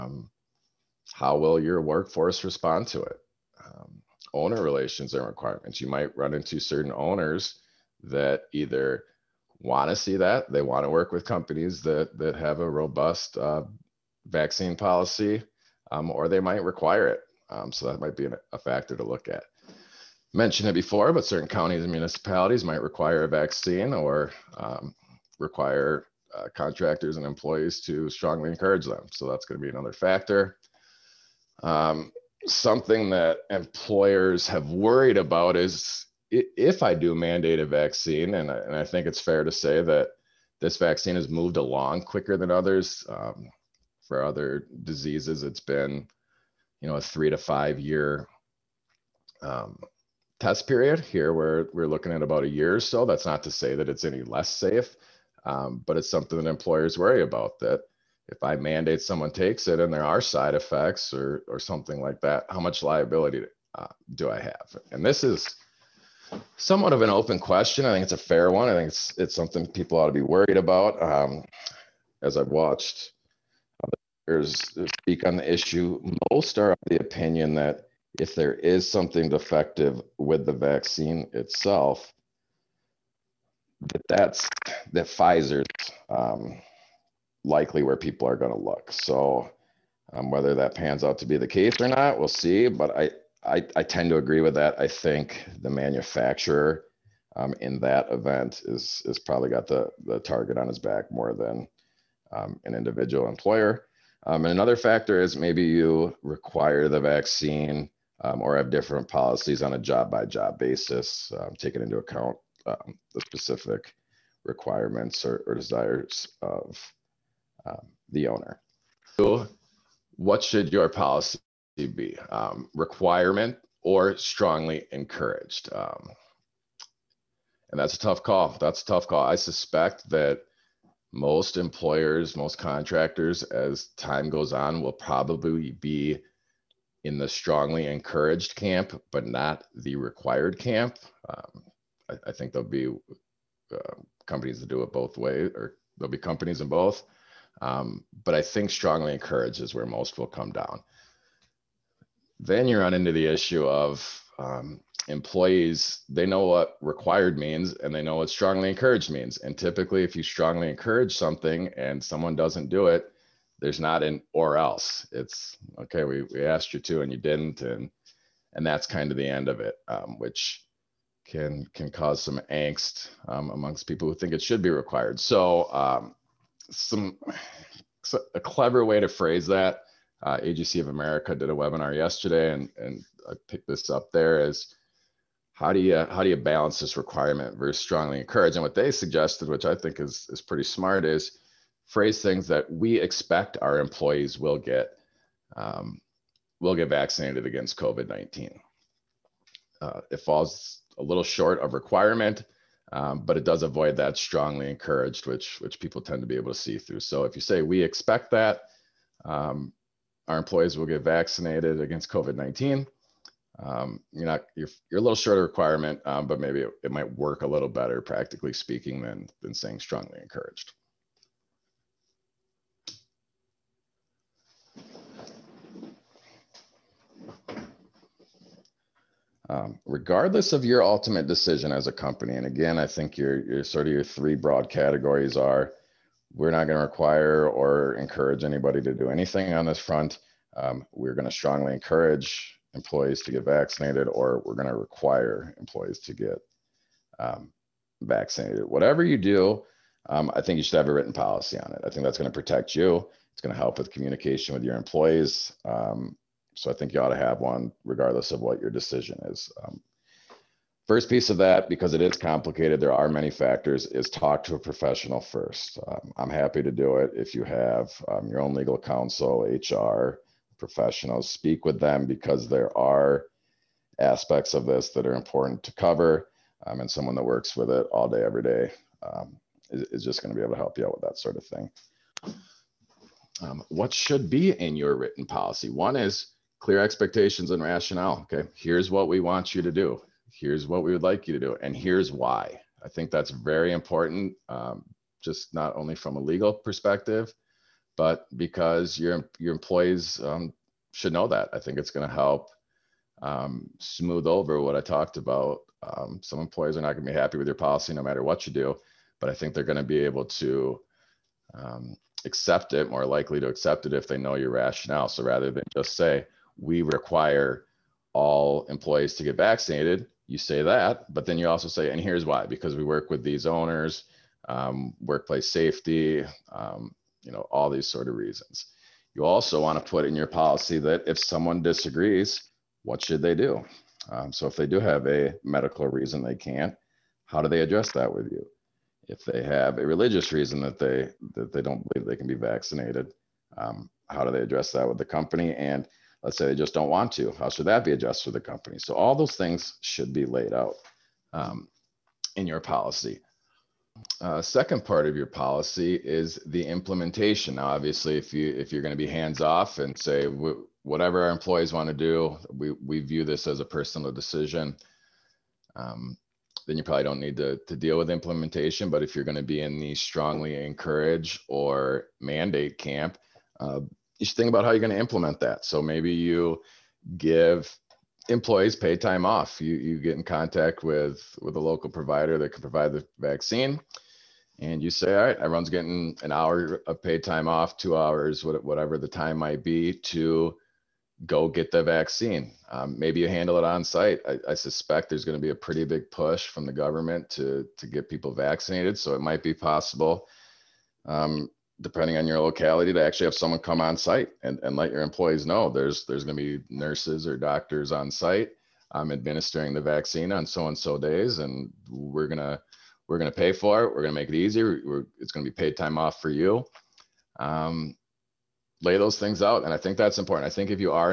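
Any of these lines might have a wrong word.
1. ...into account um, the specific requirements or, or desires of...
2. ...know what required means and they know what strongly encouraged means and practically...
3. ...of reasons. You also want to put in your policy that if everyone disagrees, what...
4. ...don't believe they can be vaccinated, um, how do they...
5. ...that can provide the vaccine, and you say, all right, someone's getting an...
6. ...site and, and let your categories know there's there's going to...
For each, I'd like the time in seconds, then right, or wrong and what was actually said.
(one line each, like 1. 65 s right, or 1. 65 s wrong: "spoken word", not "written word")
1. 111 s right
2. 156 s wrong: "typically", not "practically"
3. 328 s wrong: "someone", not "everyone"
4. 341 s right
5. 382 s wrong: "everyone", not "someone"
6. 403 s wrong: "employees", not "categories".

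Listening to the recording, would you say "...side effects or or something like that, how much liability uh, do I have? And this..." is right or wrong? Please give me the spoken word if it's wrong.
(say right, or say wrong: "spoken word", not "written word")
right.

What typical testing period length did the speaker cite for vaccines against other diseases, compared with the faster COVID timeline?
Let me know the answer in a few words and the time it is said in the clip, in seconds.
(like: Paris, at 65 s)
3 to 5 years, at 47 s.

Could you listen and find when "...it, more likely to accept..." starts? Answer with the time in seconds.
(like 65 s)
312 s.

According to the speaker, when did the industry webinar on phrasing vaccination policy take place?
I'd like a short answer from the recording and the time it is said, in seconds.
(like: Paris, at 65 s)
Yesterday, at 181 s.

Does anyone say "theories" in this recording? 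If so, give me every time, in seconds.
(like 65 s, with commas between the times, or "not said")
not said.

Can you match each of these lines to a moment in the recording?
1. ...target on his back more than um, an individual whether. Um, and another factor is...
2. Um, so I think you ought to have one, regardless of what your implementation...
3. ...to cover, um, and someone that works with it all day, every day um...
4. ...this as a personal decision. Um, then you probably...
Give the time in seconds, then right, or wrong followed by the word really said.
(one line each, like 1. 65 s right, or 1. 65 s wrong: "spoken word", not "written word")
1. 100 s wrong: "employer", not "whether"
2. 255 s wrong: "decision", not "implementation"
3. 275 s right
4. 363 s right.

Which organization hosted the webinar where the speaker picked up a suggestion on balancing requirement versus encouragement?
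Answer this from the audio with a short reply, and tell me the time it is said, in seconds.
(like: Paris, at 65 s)
AGC of America, at 180 s.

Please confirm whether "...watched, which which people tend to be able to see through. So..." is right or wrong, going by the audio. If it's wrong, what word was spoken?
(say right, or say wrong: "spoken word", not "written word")
wrong: "encouraged", not "watched".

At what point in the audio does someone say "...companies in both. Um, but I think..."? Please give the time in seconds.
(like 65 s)
146 s.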